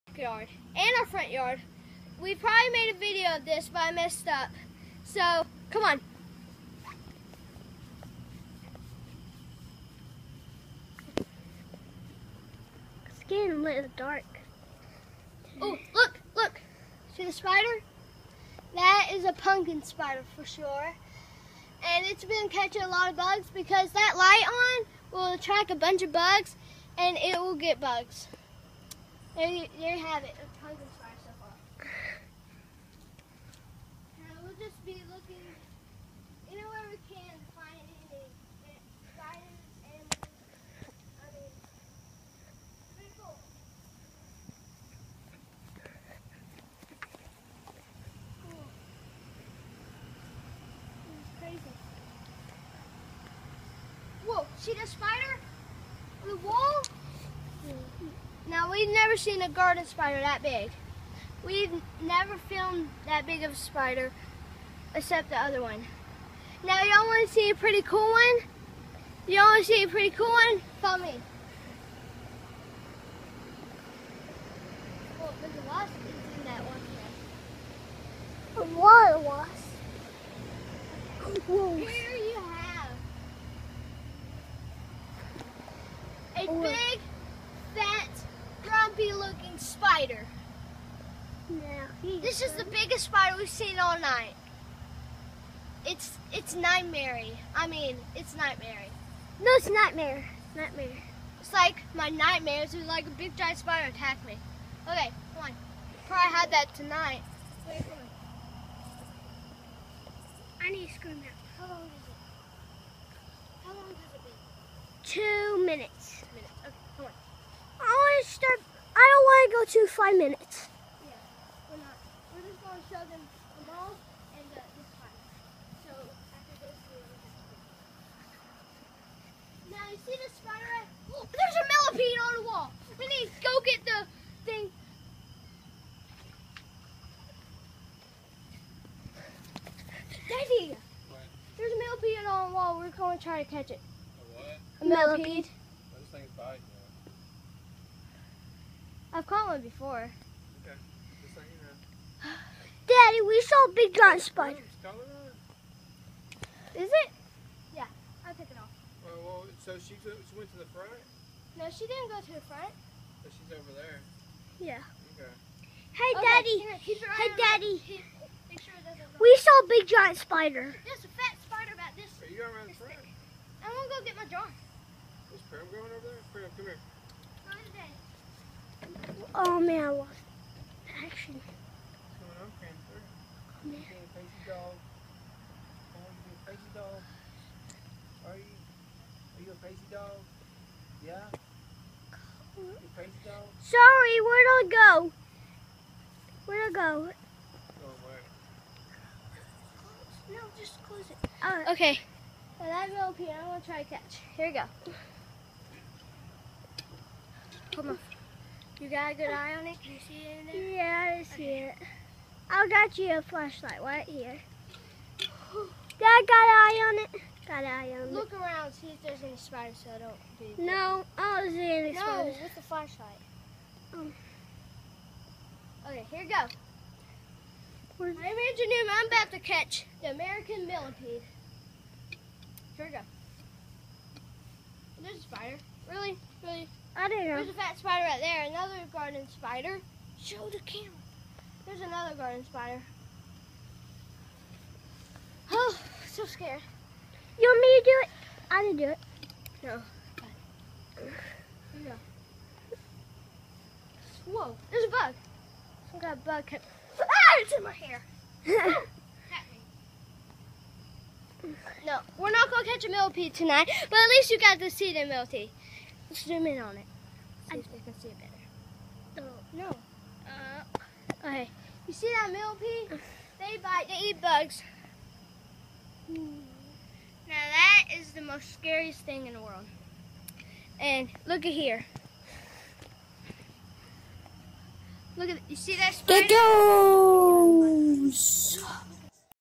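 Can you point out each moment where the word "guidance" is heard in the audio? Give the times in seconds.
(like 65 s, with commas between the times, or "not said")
39 s.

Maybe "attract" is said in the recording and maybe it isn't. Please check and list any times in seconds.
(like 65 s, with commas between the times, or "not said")
25 s.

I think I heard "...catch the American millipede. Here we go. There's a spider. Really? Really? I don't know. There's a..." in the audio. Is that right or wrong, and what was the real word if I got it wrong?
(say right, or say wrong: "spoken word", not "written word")
right.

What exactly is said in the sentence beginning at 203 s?
I'm going to try to catch.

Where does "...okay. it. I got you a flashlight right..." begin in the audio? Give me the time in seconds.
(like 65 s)
211 s.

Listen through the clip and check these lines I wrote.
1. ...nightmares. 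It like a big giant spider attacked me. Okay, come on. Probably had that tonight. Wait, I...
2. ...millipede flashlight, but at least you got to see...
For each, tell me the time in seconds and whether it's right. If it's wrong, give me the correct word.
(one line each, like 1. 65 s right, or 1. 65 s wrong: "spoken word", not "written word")
1. 102 s right
2. 262 s wrong: "tonight", not "flashlight".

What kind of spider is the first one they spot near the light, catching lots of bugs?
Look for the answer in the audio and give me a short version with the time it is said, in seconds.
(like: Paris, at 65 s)
pumpkin spider, at 19 s.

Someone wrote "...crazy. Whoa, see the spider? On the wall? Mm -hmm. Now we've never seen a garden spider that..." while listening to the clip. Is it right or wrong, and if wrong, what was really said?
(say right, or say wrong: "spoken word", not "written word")
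right.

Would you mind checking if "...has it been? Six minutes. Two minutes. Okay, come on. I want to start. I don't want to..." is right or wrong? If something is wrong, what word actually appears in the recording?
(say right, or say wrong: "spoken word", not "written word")
wrong: "Two", not "Six".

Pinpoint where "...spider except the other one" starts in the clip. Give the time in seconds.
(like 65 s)
63 s.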